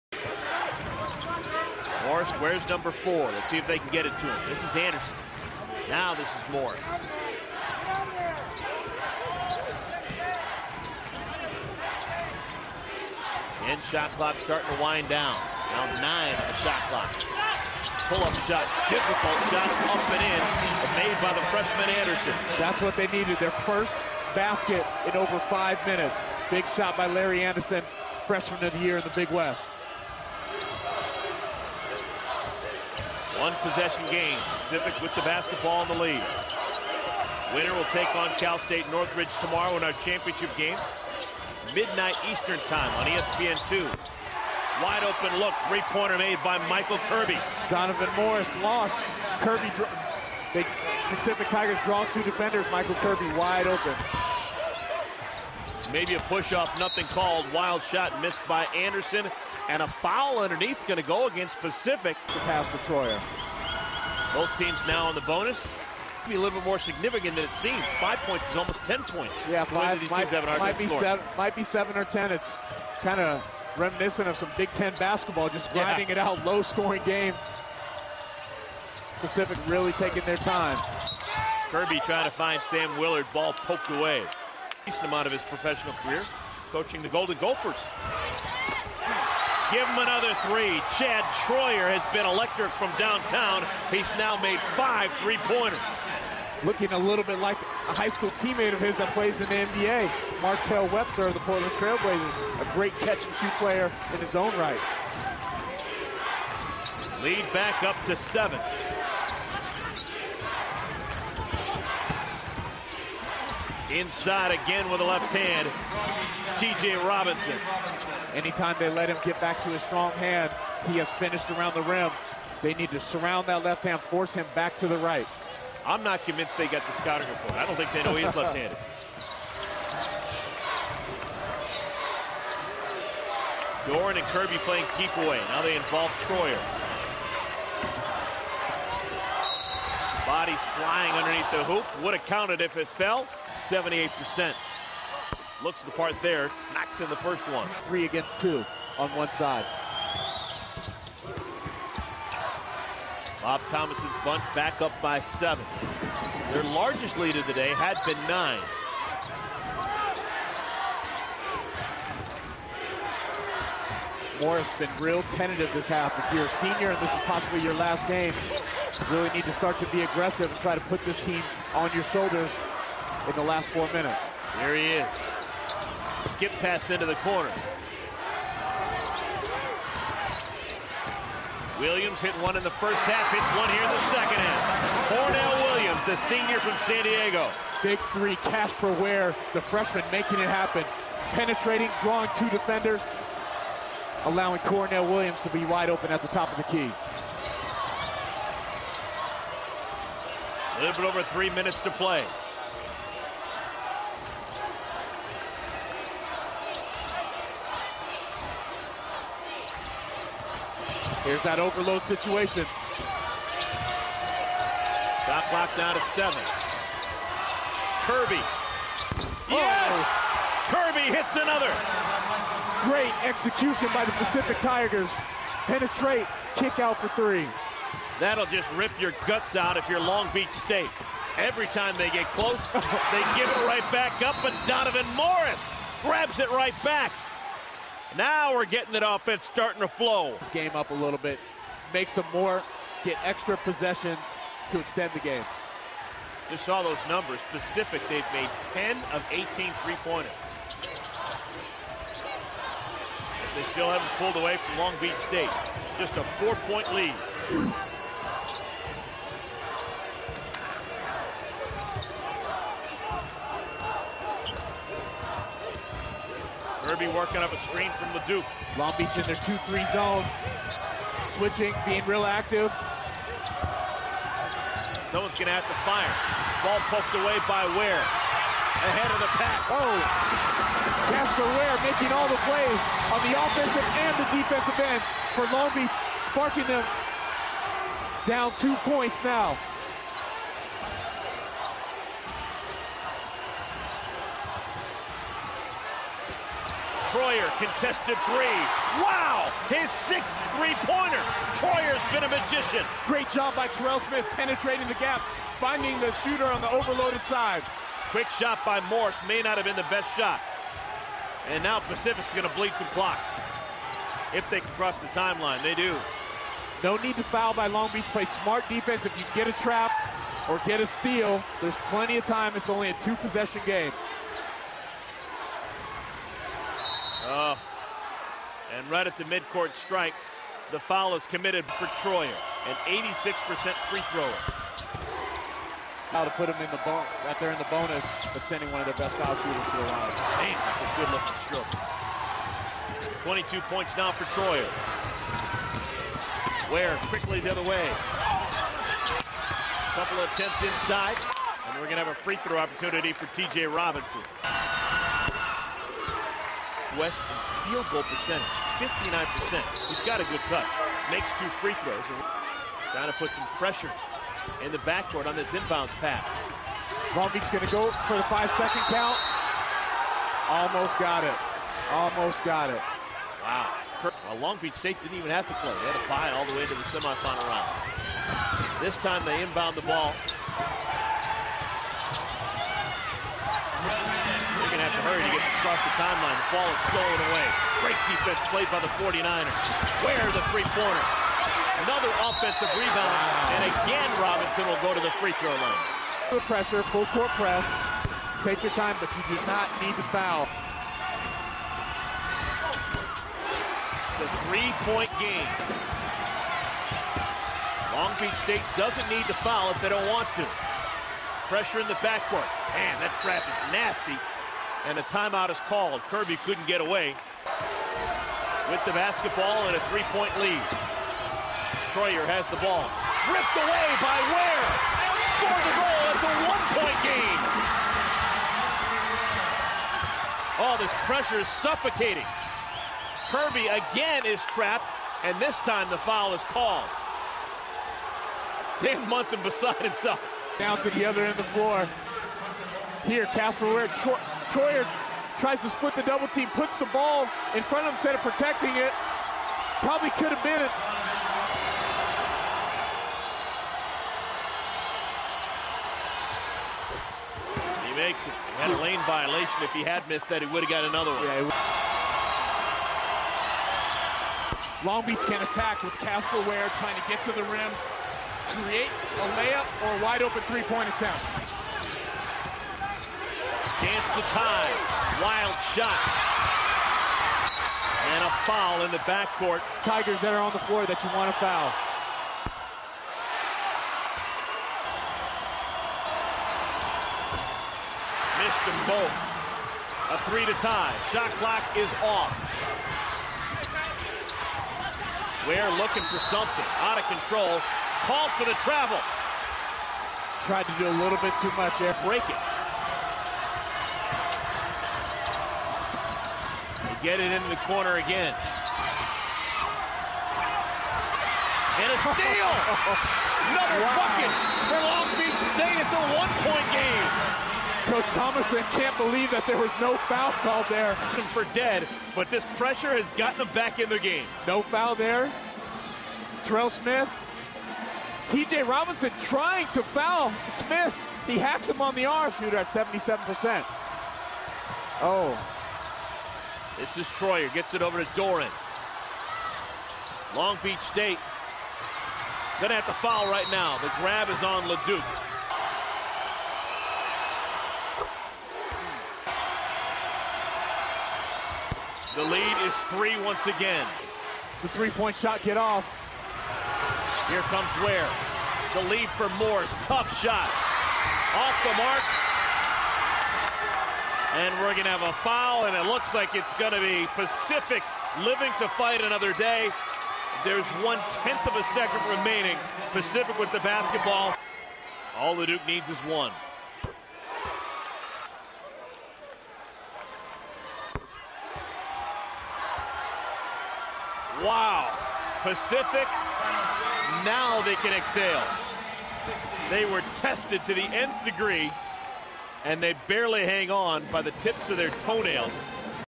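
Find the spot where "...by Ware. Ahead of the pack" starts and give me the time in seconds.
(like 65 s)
277 s.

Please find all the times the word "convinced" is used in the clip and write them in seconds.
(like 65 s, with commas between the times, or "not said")
126 s.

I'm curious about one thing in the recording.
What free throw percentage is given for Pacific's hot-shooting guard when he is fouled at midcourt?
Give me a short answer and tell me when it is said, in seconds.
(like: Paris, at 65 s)
86%, at 332 s.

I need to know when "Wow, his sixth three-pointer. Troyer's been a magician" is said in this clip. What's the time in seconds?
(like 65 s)
299 s.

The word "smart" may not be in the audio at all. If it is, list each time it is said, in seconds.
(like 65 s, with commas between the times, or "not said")
318 s.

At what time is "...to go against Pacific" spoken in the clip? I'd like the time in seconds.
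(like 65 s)
61 s.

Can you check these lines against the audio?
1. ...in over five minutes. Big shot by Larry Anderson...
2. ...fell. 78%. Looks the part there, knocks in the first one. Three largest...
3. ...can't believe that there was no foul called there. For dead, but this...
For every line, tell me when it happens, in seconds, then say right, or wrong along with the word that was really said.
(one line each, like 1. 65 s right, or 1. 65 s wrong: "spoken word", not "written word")
1. 25 s right
2. 142 s wrong: "against", not "largest"
3. 518 s right.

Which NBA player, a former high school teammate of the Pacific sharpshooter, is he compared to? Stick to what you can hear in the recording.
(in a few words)
Martell Webster.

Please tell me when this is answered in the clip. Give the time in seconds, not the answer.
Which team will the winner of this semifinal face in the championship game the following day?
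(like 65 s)
38 s.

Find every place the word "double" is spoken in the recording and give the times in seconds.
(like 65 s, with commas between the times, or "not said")
446 s.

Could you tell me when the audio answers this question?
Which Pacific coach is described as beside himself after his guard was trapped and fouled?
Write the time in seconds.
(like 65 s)
438 s.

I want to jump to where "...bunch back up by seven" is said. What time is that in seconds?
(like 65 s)
154 s.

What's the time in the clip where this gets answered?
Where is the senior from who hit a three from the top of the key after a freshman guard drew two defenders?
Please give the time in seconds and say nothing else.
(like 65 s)
186 s.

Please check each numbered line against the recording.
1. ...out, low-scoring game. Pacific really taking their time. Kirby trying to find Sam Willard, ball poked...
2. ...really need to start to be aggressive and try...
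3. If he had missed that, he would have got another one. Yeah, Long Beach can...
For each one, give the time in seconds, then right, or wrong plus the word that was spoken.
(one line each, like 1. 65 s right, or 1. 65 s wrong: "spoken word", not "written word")
1. 76 s right
2. 169 s right
3. 459 s right.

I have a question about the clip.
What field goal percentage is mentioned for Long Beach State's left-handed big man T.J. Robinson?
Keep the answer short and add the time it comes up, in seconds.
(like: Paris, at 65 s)
59%, at 358 s.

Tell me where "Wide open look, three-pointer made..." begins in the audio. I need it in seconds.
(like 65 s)
44 s.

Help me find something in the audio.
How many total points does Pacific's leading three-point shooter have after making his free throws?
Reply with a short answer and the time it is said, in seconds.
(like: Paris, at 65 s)
22, at 343 s.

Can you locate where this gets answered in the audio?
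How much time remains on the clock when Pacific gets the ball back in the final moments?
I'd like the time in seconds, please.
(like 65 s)
570 s.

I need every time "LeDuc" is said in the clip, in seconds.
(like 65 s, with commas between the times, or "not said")
268 s, 544 s, 575 s.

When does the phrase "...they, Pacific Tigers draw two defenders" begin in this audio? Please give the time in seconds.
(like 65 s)
50 s.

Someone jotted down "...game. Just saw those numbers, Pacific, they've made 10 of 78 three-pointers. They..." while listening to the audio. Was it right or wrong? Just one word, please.
wrong.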